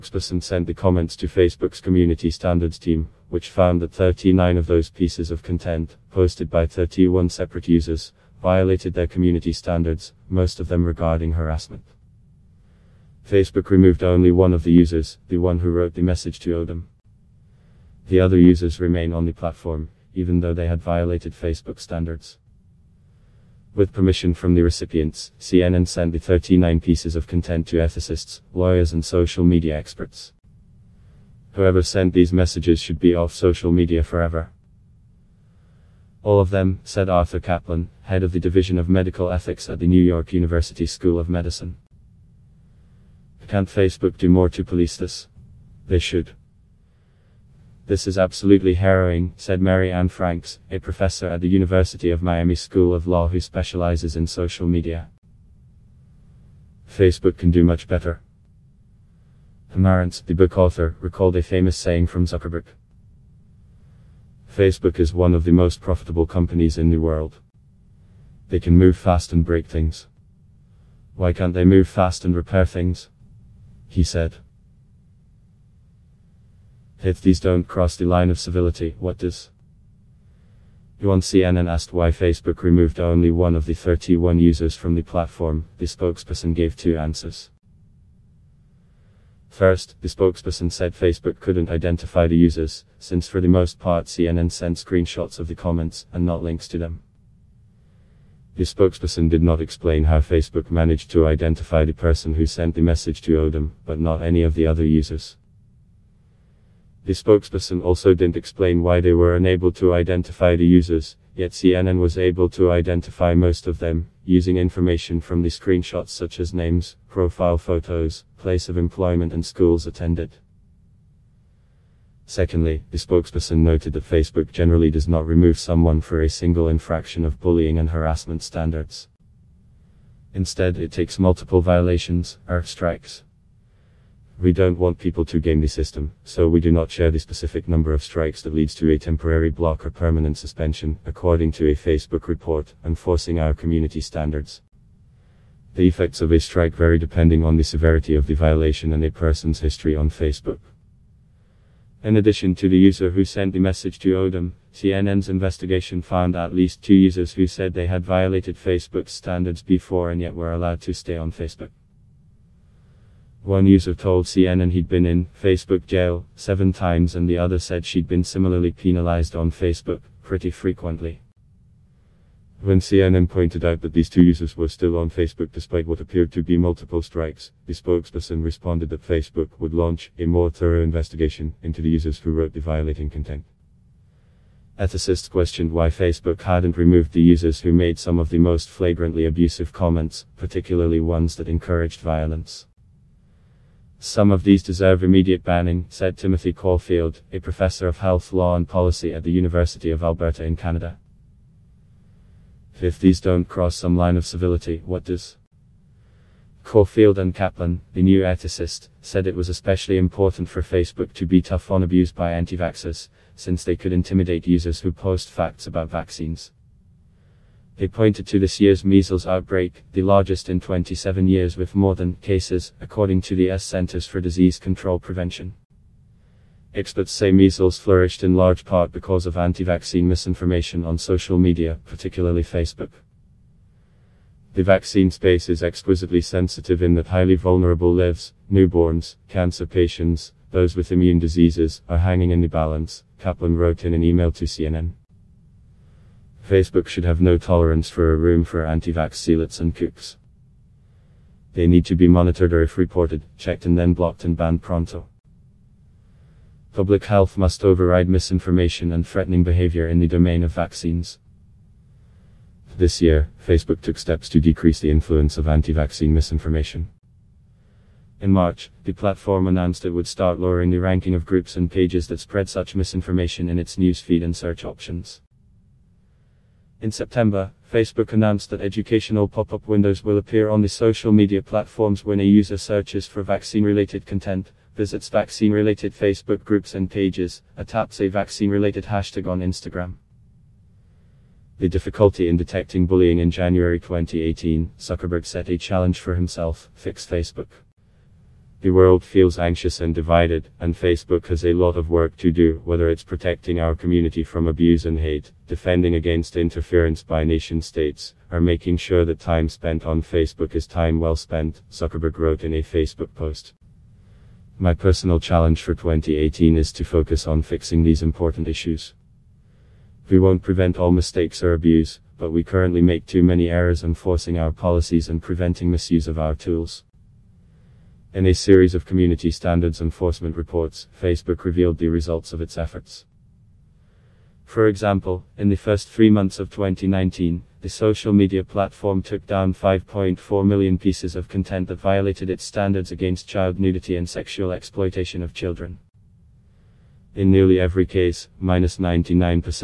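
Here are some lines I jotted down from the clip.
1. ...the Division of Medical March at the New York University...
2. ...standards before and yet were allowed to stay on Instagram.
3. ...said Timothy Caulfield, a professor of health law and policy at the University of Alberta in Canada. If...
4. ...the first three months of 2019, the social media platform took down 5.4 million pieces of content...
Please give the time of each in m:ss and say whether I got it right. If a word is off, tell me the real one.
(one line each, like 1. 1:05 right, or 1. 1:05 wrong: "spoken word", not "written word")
1. 0:38 wrong: "Ethics", not "March"
2. 2:39 wrong: "Facebook", not "Instagram"
3. 3:15 right
4. 5:35 right.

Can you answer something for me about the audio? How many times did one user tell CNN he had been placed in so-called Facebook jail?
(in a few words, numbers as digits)
7.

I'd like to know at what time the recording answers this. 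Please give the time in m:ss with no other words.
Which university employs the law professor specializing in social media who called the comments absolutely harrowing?
0:51.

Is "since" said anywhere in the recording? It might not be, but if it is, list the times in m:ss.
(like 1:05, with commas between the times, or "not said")
1:32, 3:33.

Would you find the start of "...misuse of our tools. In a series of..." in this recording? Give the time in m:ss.
5:25.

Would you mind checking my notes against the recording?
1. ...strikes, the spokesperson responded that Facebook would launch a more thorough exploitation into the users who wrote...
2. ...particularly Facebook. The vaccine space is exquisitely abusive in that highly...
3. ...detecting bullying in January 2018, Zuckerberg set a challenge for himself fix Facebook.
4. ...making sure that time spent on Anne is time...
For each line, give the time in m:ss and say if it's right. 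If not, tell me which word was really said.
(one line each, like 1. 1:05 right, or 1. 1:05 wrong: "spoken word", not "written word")
1. 2:57 wrong: "investigation", not "exploitation"
2. 3:51 wrong: "sensitive", not "abusive"
3. 4:52 right
4. 5:08 wrong: "Facebook", not "Anne".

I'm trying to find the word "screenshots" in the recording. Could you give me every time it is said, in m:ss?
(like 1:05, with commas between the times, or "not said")
1:34, 1:55.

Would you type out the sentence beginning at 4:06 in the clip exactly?
Facebook should have no tolerance for a room for anti vax zealots and kooks.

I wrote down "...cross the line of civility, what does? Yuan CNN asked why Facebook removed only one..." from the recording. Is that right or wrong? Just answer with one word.
right.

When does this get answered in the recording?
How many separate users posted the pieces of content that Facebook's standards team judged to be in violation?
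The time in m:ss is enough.
0:06.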